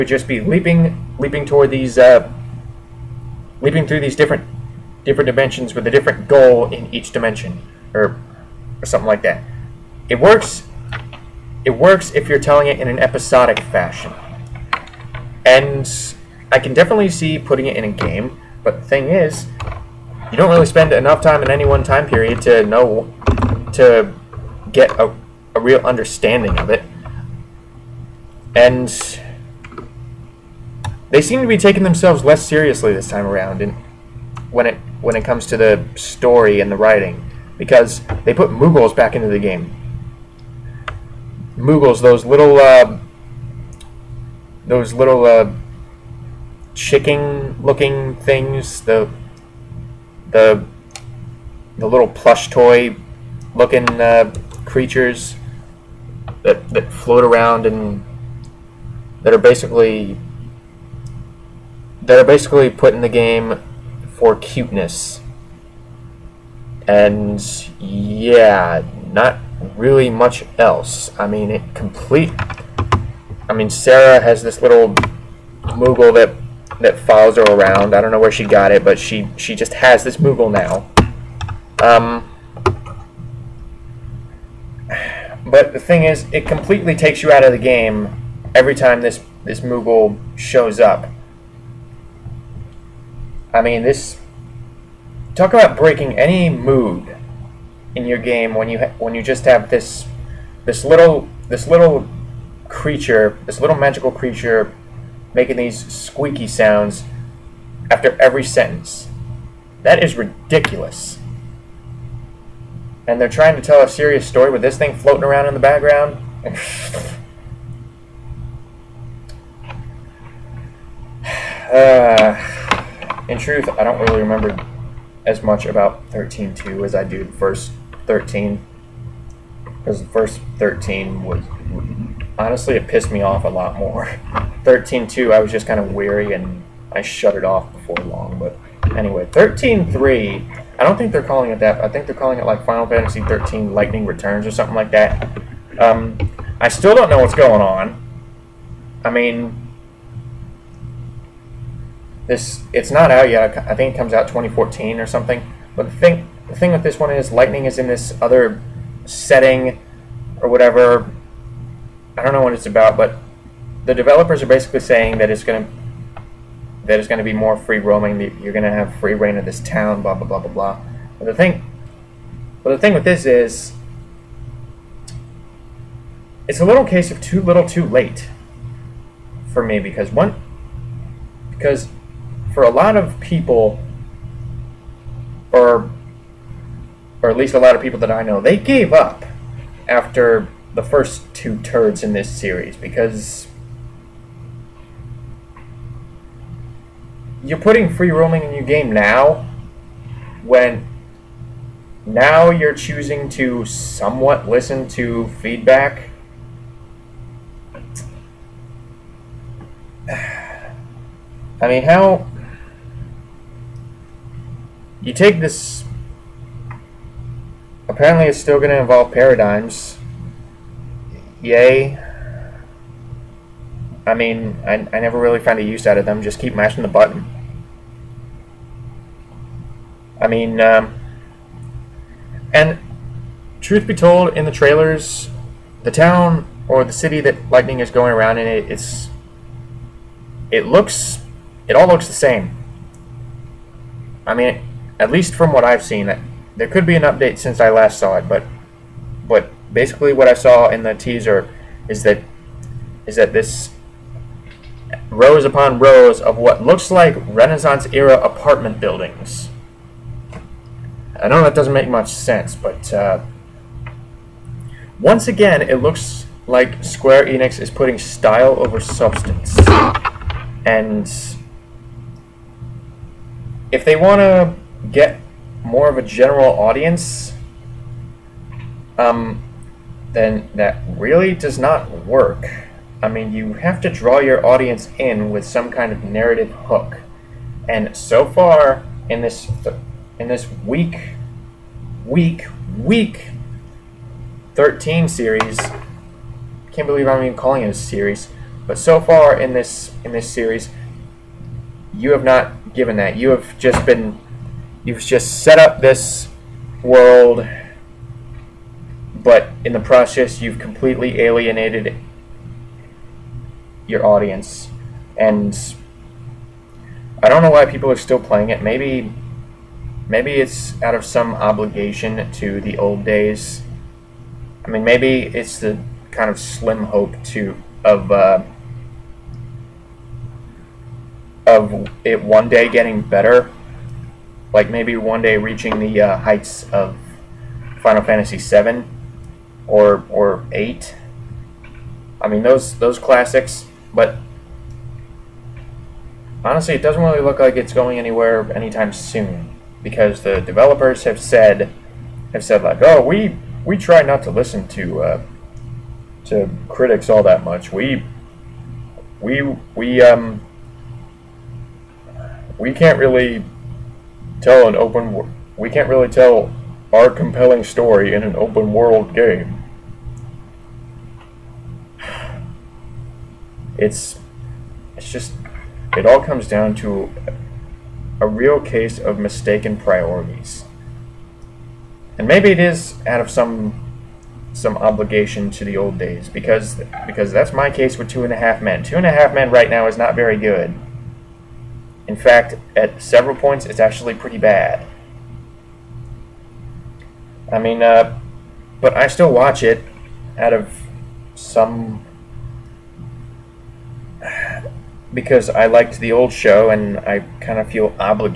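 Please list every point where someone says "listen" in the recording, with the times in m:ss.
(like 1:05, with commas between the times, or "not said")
3:24, 5:54.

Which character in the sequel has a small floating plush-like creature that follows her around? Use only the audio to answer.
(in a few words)
Sarah.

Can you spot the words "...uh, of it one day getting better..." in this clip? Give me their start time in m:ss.
5:28.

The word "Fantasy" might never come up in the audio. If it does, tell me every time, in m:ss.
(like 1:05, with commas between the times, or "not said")
2:22, 5:38.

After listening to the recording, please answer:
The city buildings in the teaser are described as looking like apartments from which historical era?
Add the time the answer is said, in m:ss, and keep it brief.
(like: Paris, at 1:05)
Renaissance, at 4:17.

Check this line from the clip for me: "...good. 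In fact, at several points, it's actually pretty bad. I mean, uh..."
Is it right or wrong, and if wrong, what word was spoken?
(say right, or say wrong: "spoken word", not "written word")
right.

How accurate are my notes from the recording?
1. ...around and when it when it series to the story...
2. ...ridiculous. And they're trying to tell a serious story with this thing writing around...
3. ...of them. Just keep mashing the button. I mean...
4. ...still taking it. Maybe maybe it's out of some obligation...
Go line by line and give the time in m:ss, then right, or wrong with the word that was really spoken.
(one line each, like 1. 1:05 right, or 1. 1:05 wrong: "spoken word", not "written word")
1. 0:33 wrong: "comes", not "series"
2. 1:50 wrong: "floating", not "writing"
3. 3:45 right
4. 5:17 wrong: "playing", not "taking".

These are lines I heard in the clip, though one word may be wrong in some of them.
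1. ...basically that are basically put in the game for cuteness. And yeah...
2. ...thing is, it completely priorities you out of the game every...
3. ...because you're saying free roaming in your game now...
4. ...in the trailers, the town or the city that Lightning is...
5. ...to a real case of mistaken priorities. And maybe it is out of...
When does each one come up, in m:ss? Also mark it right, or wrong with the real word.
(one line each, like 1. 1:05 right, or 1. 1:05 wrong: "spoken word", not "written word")
1. 0:59 right
2. 1:25 wrong: "takes", not "priorities"
3. 3:12 wrong: "putting", not "saying"
4. 3:54 right
5. 6:16 right.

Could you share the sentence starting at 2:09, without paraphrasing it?
Because the first 13 was, honestly, it pissed me off a lot more.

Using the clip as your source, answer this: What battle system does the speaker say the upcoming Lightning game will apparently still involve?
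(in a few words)
Paradigms.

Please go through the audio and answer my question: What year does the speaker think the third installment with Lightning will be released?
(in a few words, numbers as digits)
2014.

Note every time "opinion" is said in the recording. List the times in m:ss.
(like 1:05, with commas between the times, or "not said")
not said.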